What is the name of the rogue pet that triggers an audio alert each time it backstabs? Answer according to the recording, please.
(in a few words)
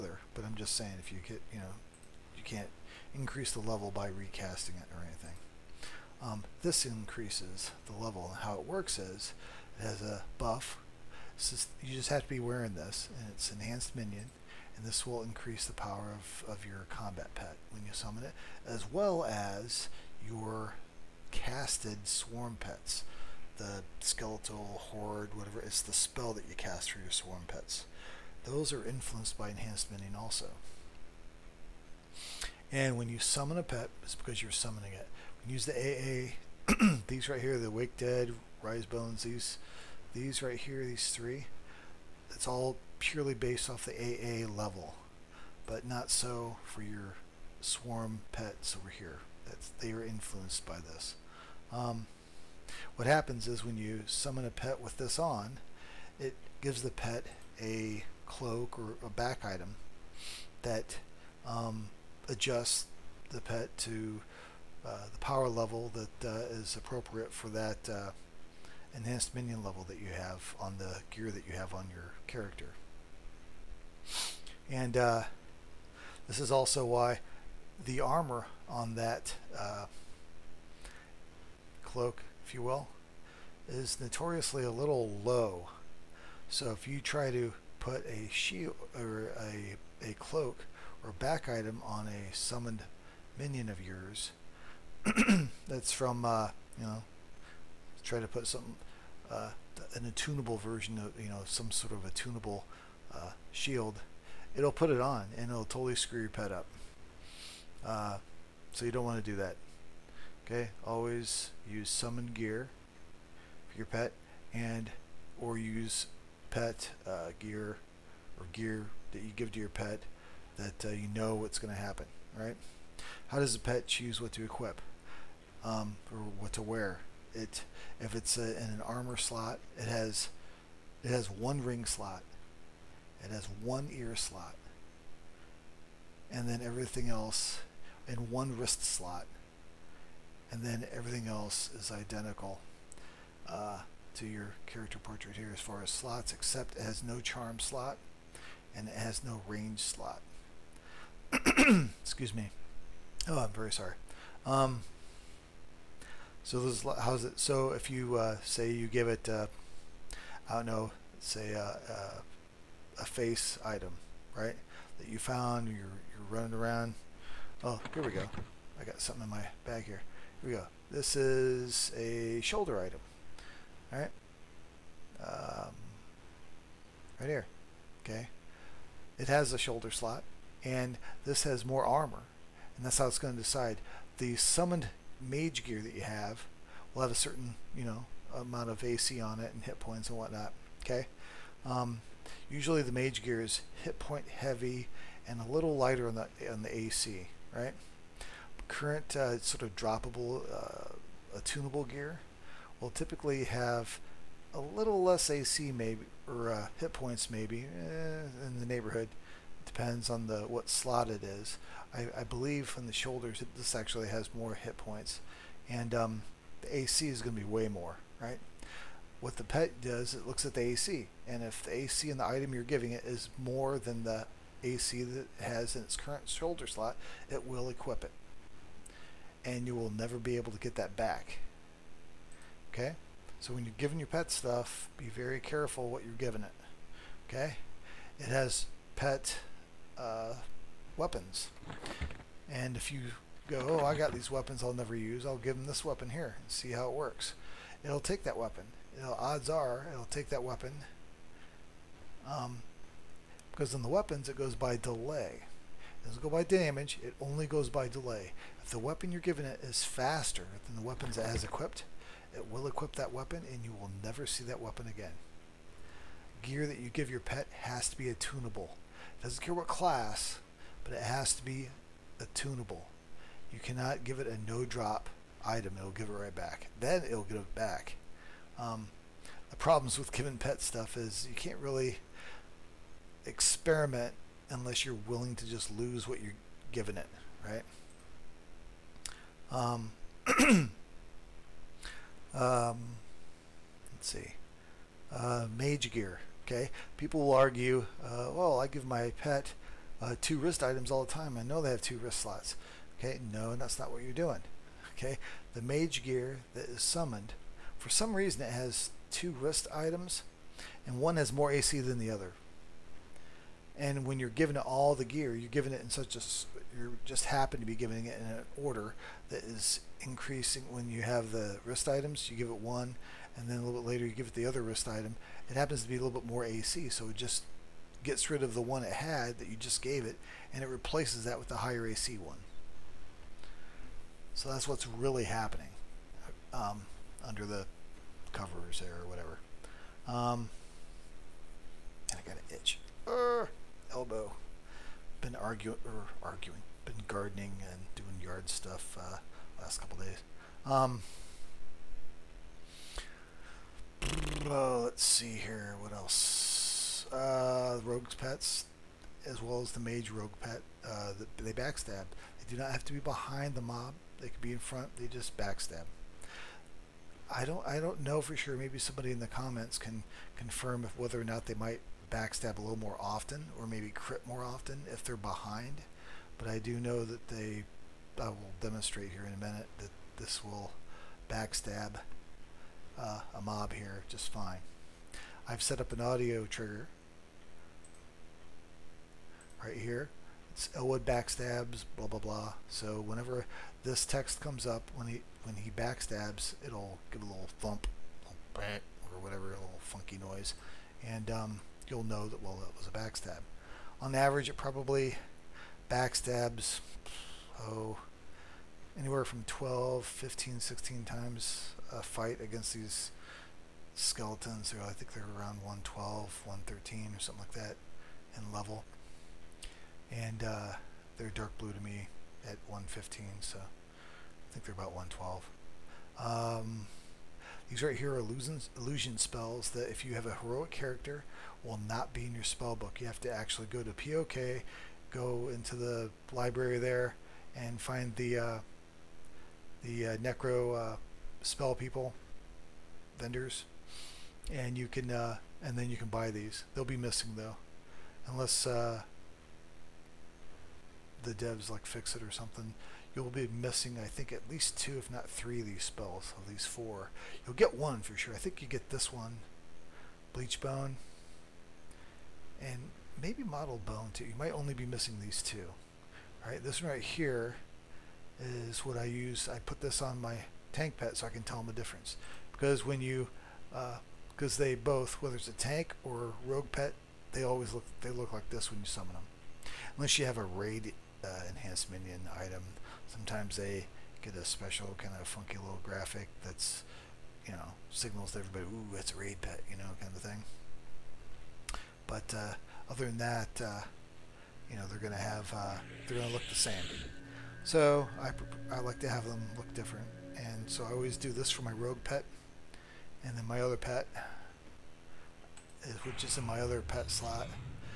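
Elwood.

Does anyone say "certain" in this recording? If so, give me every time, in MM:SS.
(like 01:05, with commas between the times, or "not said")
03:07.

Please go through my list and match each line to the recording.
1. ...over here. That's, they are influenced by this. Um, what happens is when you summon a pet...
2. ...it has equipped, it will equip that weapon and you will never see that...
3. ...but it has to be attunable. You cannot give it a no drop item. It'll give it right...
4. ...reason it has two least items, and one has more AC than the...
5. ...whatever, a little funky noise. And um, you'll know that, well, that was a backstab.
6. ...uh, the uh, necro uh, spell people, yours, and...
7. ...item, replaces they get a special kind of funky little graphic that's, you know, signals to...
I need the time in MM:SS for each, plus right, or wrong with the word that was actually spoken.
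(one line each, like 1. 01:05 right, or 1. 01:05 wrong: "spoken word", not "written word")
1. 00:48 right
2. 04:21 right
3. 04:30 right
4. 05:08 wrong: "wrist", not "least"
5. 06:39 right
6. 07:18 wrong: "vendors", not "yours"
7. 08:02 wrong: "sometimes", not "replaces".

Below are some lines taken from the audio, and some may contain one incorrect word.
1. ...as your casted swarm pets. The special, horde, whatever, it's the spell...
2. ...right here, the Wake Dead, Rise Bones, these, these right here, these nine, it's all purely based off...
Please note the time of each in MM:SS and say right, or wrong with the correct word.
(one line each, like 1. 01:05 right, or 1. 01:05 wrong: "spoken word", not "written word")
1. 00:19 wrong: "skeletal", not "special"
2. 00:37 wrong: "three", not "nine".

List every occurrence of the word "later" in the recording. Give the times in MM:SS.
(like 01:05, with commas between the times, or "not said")
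05:23.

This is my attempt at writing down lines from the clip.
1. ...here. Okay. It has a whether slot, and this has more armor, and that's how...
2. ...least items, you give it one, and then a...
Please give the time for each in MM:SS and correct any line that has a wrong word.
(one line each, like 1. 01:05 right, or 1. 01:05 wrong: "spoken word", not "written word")
1. 02:57 wrong: "shoulder", not "whether"
2. 05:21 wrong: "wrist", not "least".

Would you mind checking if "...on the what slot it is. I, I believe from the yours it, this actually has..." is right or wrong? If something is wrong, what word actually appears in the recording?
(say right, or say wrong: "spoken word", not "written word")
wrong: "shoulders", not "yours".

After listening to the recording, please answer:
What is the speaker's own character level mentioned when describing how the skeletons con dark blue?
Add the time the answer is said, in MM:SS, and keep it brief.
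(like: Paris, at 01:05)
115, at 07:02.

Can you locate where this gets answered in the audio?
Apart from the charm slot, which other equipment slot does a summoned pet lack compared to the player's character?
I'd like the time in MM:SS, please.
02:29.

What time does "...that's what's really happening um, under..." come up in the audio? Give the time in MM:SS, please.
05:34.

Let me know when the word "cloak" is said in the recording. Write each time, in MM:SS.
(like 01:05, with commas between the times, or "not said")
00:58, 01:21, 01:30.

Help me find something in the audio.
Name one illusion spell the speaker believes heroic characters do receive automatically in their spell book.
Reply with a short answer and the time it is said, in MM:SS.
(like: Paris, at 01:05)
Bleach Bone, at 07:40.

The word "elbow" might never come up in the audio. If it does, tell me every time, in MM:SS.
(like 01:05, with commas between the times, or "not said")
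05:43.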